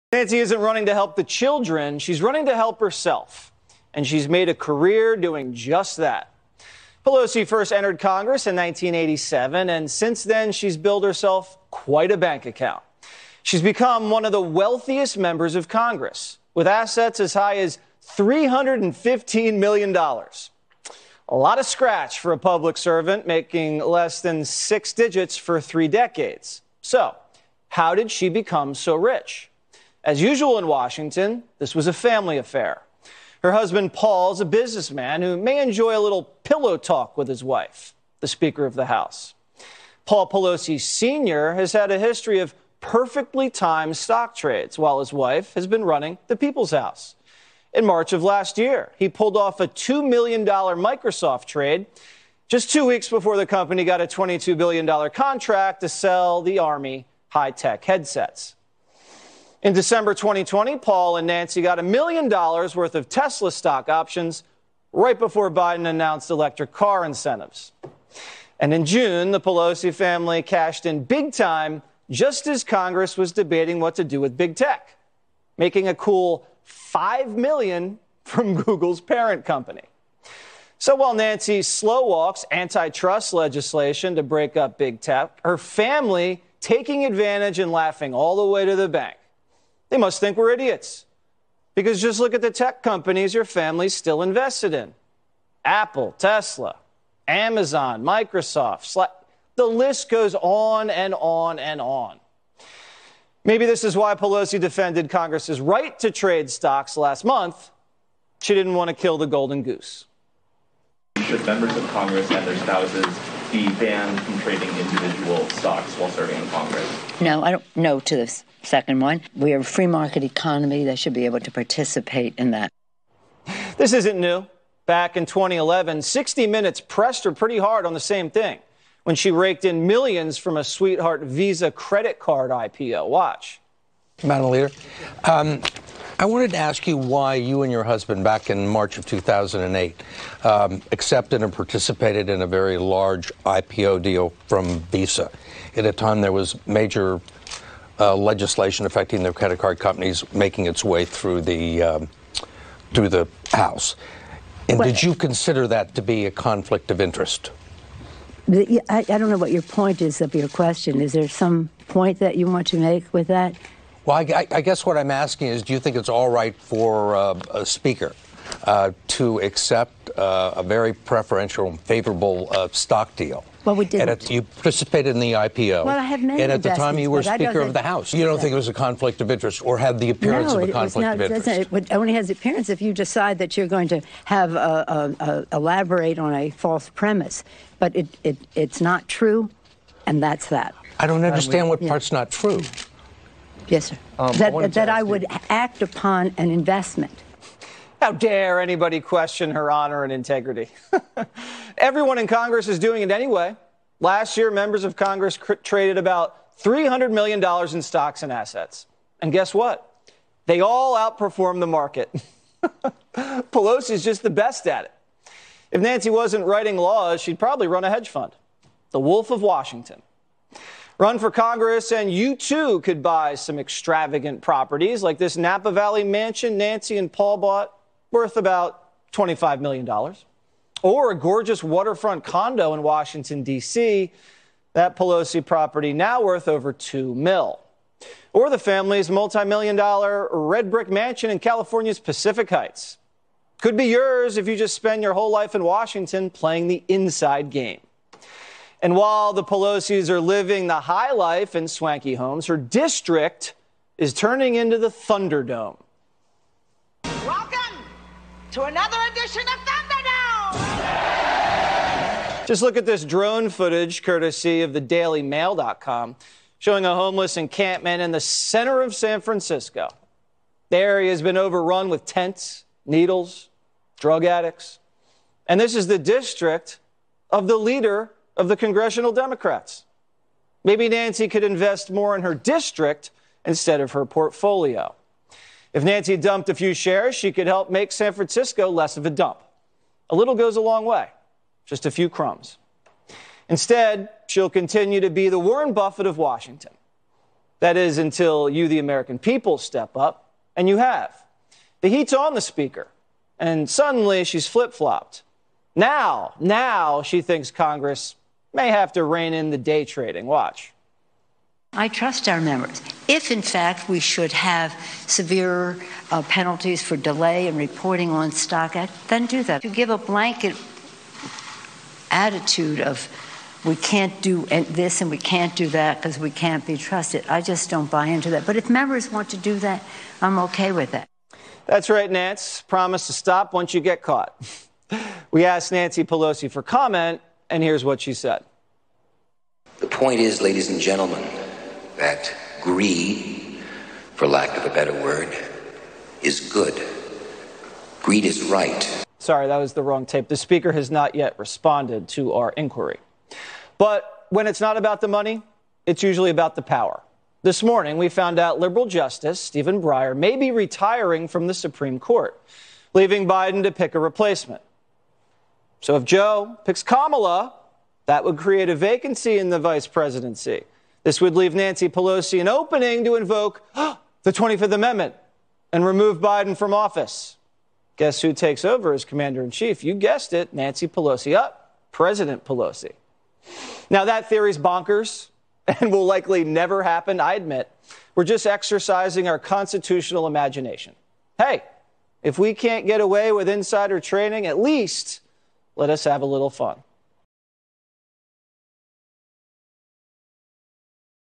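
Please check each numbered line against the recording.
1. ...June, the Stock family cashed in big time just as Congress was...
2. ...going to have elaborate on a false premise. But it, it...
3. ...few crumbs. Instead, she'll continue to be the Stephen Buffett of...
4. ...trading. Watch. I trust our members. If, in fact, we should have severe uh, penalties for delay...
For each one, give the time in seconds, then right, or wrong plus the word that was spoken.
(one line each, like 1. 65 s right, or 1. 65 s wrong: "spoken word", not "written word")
1. 68 s wrong: "Pelosi", not "Stock"
2. 183 s right
3. 291 s wrong: "Warren", not "Stephen"
4. 309 s right.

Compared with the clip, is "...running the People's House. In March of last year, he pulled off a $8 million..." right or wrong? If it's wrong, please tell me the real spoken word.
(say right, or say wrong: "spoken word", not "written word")
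wrong: "2", not "8".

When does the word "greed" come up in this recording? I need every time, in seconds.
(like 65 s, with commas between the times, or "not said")
342 s, 348 s.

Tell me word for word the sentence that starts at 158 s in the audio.
I, I don't know what your point is of your question.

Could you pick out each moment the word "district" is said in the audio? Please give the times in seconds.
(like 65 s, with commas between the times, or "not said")
252 s, 275 s, 282 s.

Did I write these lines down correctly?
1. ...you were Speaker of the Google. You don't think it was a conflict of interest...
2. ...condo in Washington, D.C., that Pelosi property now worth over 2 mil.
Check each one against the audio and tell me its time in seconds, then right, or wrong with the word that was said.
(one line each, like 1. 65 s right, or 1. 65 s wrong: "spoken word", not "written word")
1. 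176 s wrong: "House", not "Google"
2. 232 s right.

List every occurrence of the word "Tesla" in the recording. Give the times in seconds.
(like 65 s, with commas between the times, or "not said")
63 s, 96 s.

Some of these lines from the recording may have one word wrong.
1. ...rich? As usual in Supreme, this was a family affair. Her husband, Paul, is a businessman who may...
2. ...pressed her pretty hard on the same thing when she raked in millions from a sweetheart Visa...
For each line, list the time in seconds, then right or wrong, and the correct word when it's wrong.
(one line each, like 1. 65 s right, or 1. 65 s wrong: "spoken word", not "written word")
1. 28 s wrong: "Washington", not "Supreme"
2. 126 s right.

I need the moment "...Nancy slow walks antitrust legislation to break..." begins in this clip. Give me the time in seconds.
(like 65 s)
81 s.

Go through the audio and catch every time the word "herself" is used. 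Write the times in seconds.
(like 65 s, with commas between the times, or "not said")
2 s, 11 s.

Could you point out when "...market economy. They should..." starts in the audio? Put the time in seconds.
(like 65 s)
119 s.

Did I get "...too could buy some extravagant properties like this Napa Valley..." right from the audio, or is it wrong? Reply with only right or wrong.
right.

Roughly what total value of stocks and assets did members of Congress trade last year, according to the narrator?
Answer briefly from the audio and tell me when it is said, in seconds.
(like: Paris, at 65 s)
$300 million, at 206 s.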